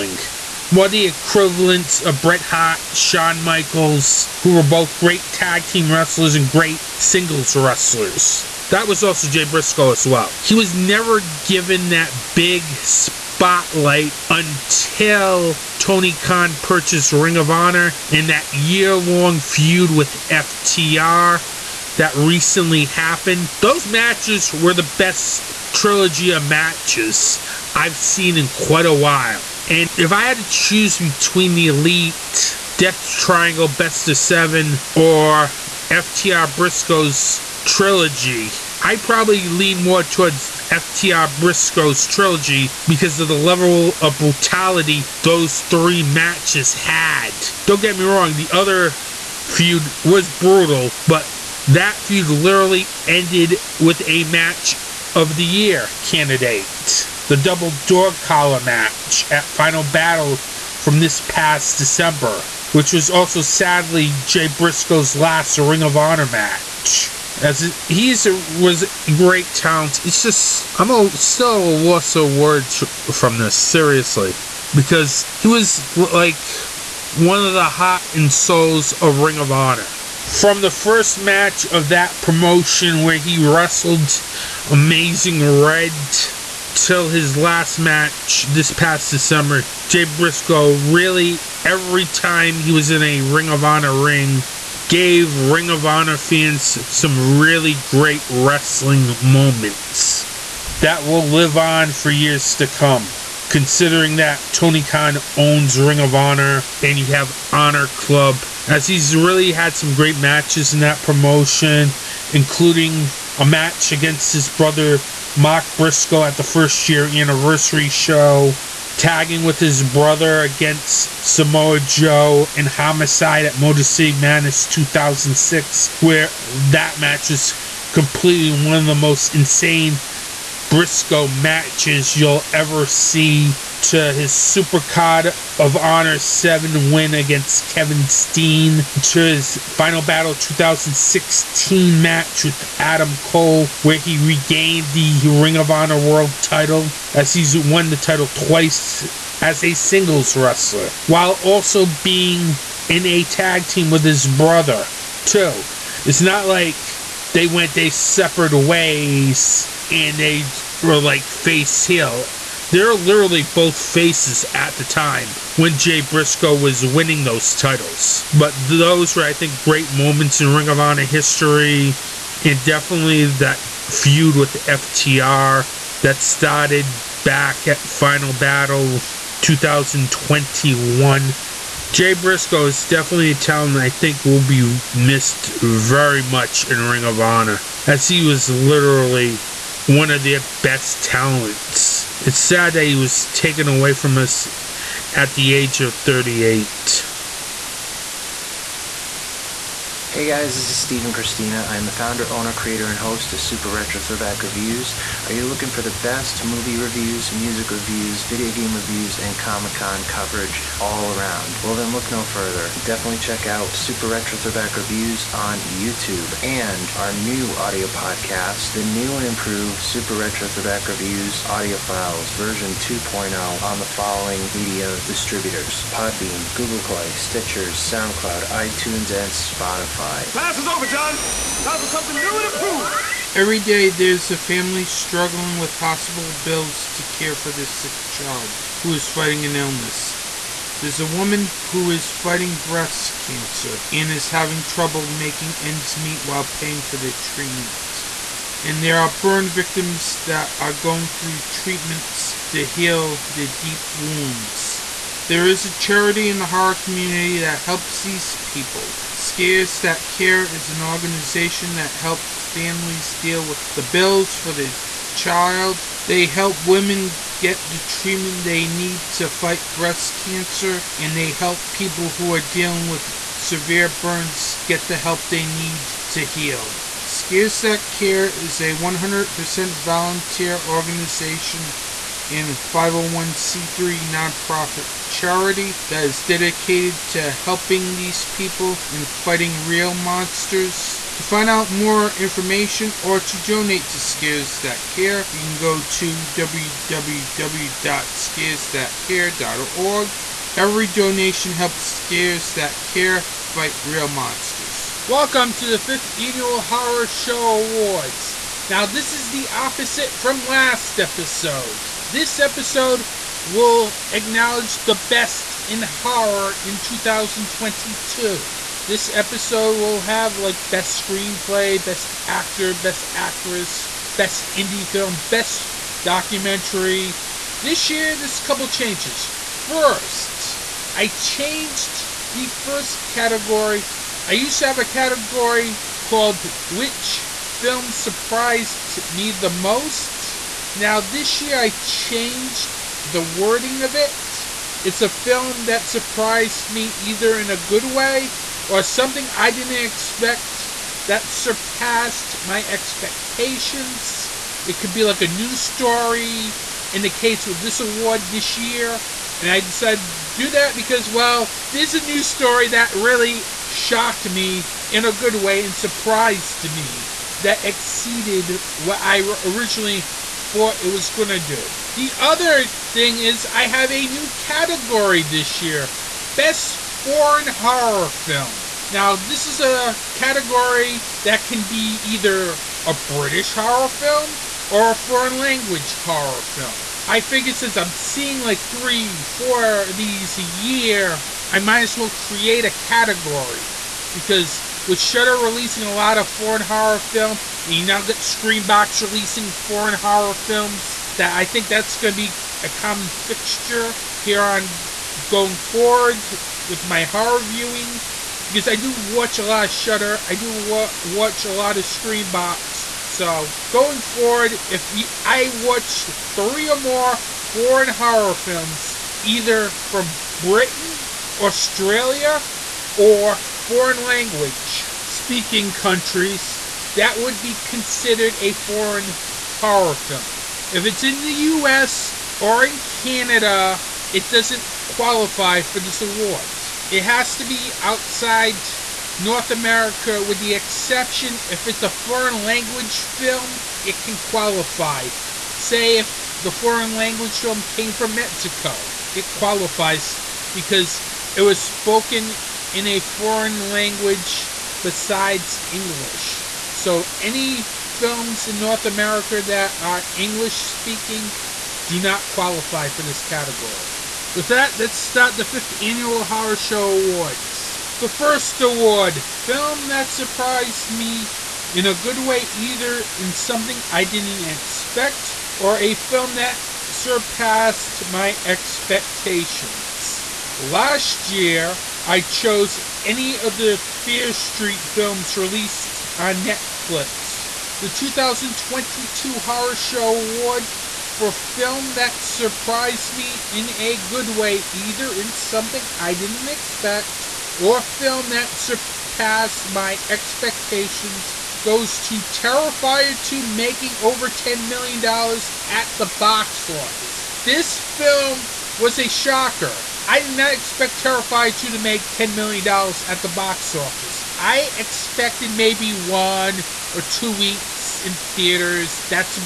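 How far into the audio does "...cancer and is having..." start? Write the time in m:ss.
4:03.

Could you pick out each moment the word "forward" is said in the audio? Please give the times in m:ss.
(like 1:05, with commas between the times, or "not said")
6:45, 6:54.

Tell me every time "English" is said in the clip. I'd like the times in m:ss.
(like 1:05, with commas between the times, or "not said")
7:35, 7:40.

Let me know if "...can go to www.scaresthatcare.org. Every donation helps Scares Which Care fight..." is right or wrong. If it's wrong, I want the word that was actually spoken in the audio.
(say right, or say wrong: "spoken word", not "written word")
wrong: "That", not "Which".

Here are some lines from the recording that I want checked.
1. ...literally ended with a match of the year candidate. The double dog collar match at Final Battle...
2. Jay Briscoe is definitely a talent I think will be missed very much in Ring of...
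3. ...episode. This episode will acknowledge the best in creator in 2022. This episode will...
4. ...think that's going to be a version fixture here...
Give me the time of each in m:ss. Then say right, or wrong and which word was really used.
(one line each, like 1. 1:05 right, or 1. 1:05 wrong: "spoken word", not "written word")
1. 0:52 right
2. 3:01 right
3. 5:10 wrong: "horror", not "creator"
4. 6:41 wrong: "common", not "version".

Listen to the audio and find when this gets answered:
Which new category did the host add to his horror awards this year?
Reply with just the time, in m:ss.
6:16.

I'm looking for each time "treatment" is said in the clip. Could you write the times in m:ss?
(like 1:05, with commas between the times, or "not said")
4:07, 4:11, 4:27.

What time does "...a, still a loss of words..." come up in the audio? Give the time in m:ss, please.
1:10.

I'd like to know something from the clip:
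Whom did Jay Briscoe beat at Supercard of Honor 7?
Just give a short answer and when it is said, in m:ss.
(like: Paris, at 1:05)
Kevin Steen, at 2:17.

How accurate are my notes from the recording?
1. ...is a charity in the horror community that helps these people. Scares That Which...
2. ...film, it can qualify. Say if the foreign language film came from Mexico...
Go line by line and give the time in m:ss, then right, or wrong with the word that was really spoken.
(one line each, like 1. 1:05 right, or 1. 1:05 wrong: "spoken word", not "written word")
1. 4:15 wrong: "Care", not "Which"
2. 7:23 right.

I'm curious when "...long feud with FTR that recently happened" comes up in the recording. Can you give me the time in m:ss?
0:18.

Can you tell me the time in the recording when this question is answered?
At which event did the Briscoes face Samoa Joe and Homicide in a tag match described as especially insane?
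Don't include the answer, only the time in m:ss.
2:03.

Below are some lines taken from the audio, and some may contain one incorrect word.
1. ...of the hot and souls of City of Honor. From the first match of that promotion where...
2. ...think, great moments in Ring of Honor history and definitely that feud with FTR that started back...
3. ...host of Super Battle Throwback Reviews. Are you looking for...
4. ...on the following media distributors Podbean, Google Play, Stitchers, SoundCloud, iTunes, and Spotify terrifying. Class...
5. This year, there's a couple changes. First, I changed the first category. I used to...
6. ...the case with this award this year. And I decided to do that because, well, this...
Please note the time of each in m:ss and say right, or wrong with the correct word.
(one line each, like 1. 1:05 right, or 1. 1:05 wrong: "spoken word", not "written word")
1. 1:17 wrong: "Ring", not "City"
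2. 2:49 right
3. 3:22 wrong: "Retro", not "Battle"
4. 3:43 right
5. 5:27 right
6. 5:57 right.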